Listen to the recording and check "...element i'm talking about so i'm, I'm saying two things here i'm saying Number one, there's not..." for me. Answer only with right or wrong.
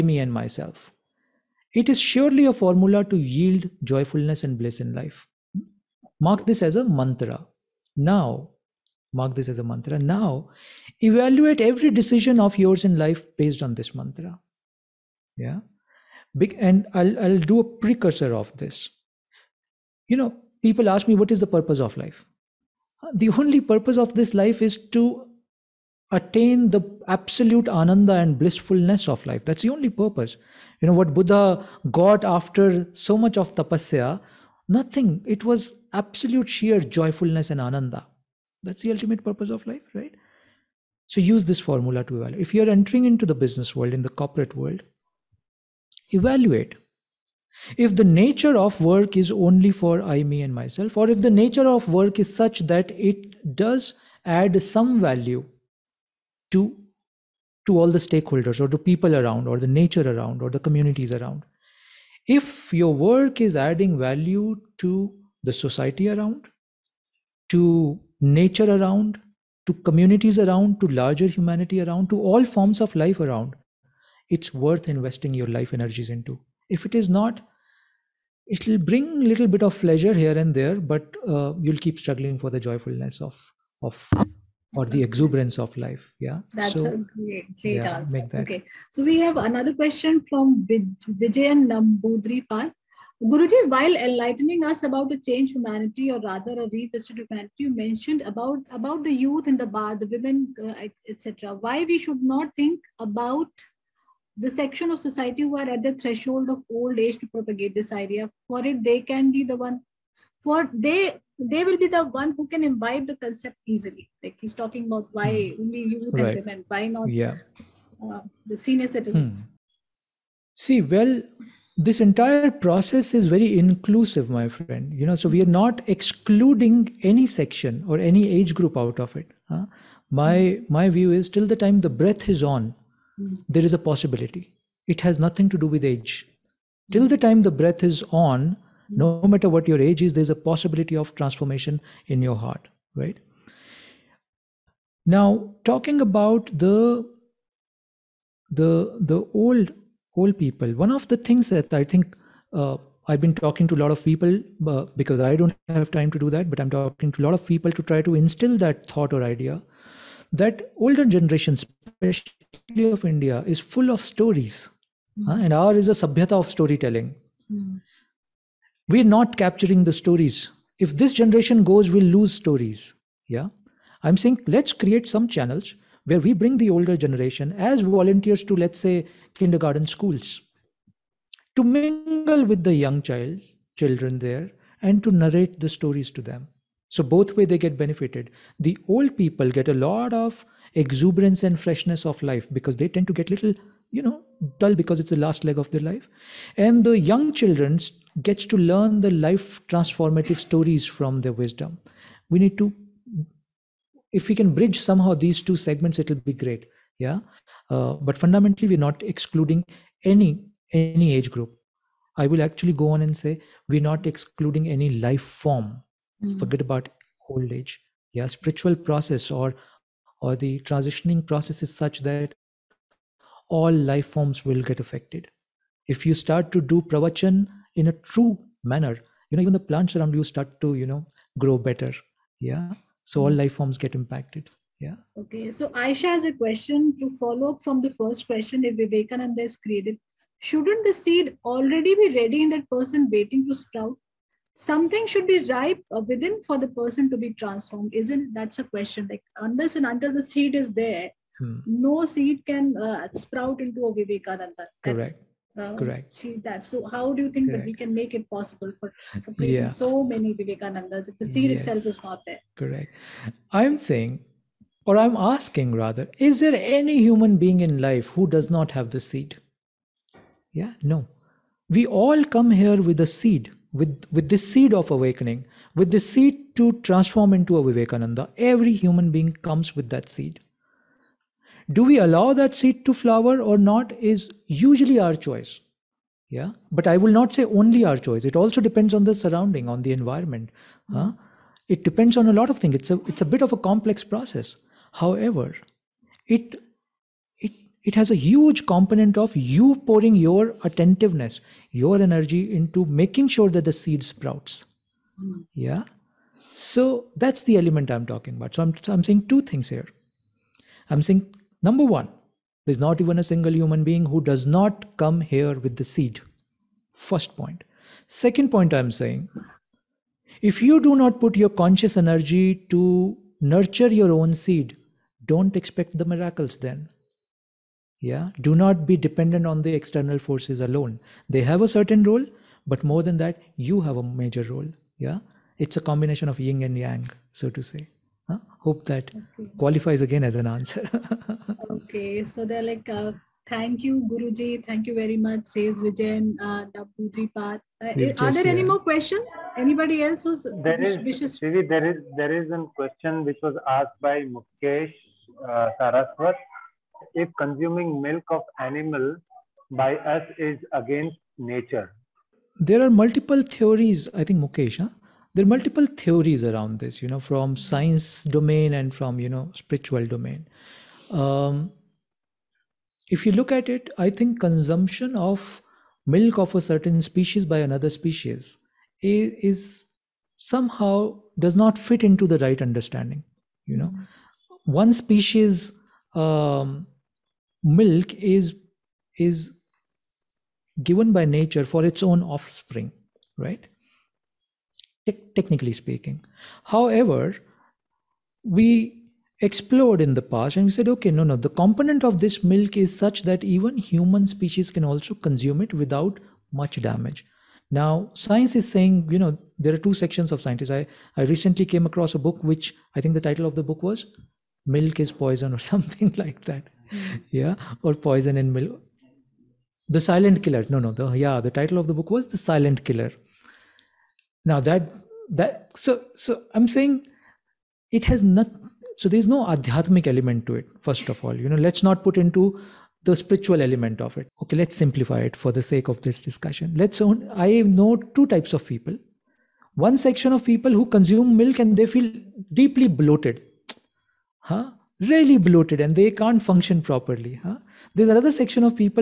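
right.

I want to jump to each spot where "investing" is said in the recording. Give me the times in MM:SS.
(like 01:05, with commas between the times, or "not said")
01:14.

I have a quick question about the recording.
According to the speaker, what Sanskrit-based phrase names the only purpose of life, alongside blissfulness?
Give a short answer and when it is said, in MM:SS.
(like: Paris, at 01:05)
absolute ananda, at 00:27.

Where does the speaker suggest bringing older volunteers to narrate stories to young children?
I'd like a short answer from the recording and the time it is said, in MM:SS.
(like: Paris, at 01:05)
kindergarten schools, at 02:59.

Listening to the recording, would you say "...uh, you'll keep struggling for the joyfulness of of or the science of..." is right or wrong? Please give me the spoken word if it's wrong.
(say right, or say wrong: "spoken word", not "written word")
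wrong: "exuberance", not "science".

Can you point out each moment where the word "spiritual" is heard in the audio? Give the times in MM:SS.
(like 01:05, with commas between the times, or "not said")
03:38, 06:09, 07:13.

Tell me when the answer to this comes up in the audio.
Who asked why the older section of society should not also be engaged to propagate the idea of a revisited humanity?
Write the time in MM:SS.
01:31.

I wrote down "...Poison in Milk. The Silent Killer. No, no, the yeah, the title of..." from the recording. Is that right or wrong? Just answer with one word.
right.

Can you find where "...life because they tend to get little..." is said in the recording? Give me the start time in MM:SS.
03:12.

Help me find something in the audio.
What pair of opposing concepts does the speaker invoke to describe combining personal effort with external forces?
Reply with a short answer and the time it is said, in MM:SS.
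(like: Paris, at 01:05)
yin and yang, at 05:36.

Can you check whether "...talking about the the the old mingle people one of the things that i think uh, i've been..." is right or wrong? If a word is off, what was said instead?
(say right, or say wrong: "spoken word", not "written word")
wrong: "whole", not "mingle".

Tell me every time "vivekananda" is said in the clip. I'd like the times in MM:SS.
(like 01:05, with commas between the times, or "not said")
03:58, 04:13, 04:20, 04:37.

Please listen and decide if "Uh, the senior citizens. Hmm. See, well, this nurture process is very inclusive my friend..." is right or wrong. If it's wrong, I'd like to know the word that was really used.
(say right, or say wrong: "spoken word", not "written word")
wrong: "entire", not "nurture".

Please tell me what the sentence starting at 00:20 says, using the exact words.
You know, people ask me, what is the purpose of life?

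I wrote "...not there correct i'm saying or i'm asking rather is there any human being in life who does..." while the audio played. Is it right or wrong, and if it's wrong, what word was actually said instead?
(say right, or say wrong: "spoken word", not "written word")
right.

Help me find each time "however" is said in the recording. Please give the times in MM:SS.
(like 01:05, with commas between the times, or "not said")
04:55, 06:36.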